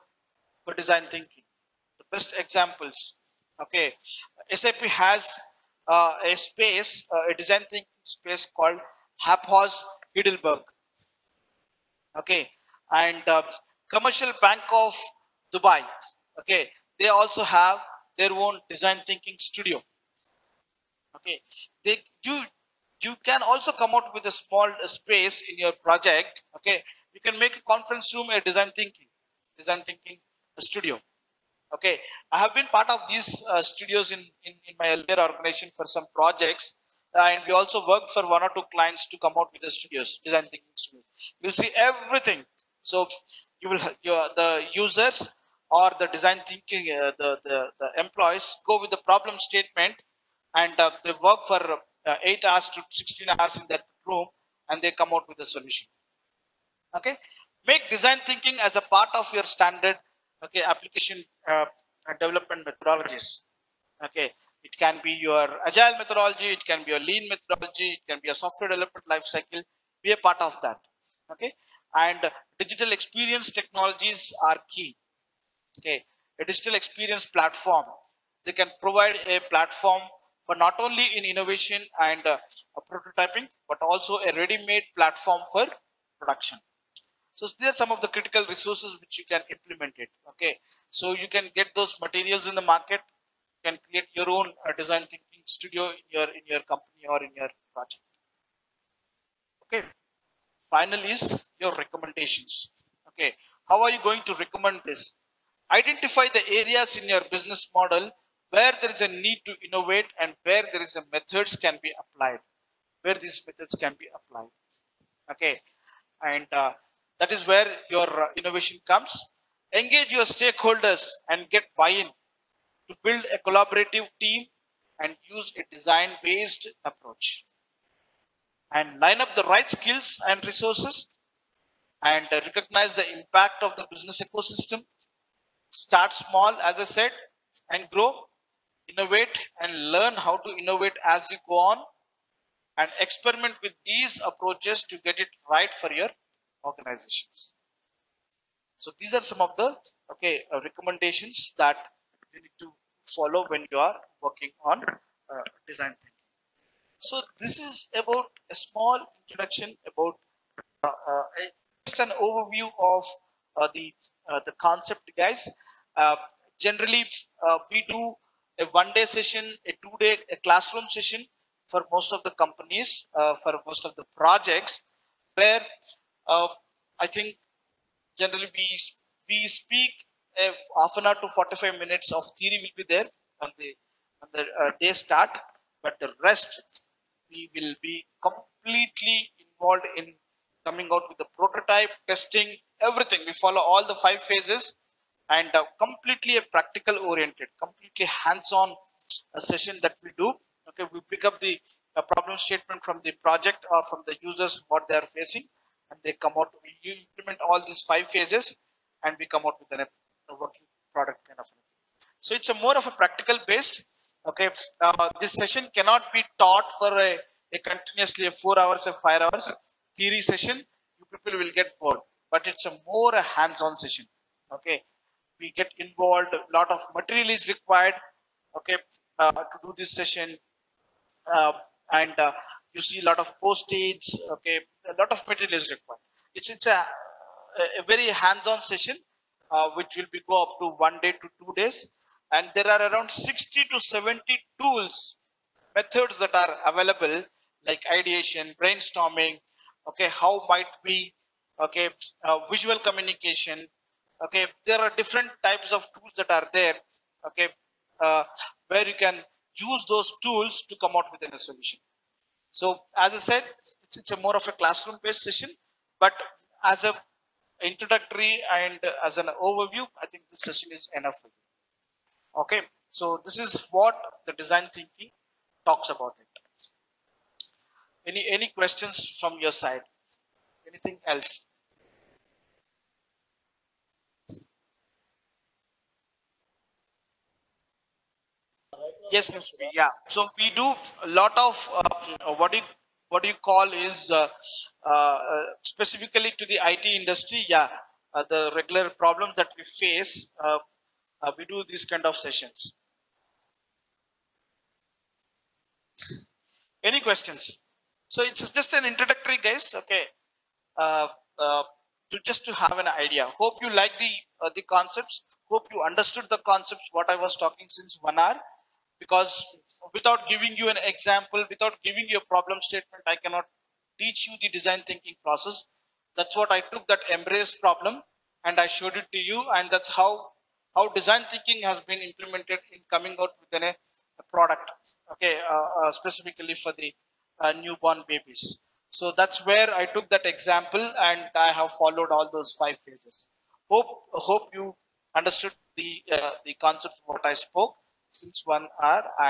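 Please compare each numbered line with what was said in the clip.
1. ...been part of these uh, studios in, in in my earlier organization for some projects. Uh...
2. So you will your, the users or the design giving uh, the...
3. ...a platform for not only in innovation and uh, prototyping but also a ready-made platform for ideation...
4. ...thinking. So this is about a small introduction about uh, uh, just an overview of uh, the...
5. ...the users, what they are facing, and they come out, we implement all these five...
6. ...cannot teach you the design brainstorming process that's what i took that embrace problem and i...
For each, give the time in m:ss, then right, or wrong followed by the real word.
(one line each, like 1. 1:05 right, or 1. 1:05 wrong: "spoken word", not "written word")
1. 0:32 right
2. 0:42 wrong: "thinking", not "giving"
3. 1:19 wrong: "production", not "ideation"
4. 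2:35 right
5. 3:24 right
6. 5:23 wrong: "thinking", not "brainstorming".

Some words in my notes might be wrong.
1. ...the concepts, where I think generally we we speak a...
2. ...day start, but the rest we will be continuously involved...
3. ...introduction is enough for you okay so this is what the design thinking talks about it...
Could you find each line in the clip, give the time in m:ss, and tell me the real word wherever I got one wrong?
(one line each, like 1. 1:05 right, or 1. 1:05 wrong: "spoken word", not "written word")
1. 2:53 wrong: "projects", not "concepts"
2. 3:04 wrong: "completely", not "continuously"
3. 4:30 wrong: "session", not "introduction".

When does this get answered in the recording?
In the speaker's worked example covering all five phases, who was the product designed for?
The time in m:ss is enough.
5:37.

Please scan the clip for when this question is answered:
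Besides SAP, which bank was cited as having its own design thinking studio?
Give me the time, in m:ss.
0:13.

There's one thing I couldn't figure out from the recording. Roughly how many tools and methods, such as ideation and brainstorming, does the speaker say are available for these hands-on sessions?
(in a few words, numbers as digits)
60 to 70.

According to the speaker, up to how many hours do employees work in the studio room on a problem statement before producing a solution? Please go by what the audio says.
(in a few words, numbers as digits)
16 hours.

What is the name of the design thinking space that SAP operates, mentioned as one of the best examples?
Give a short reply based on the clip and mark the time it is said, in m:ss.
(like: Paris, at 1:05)
AppHaus Heidelberg, at 0:09.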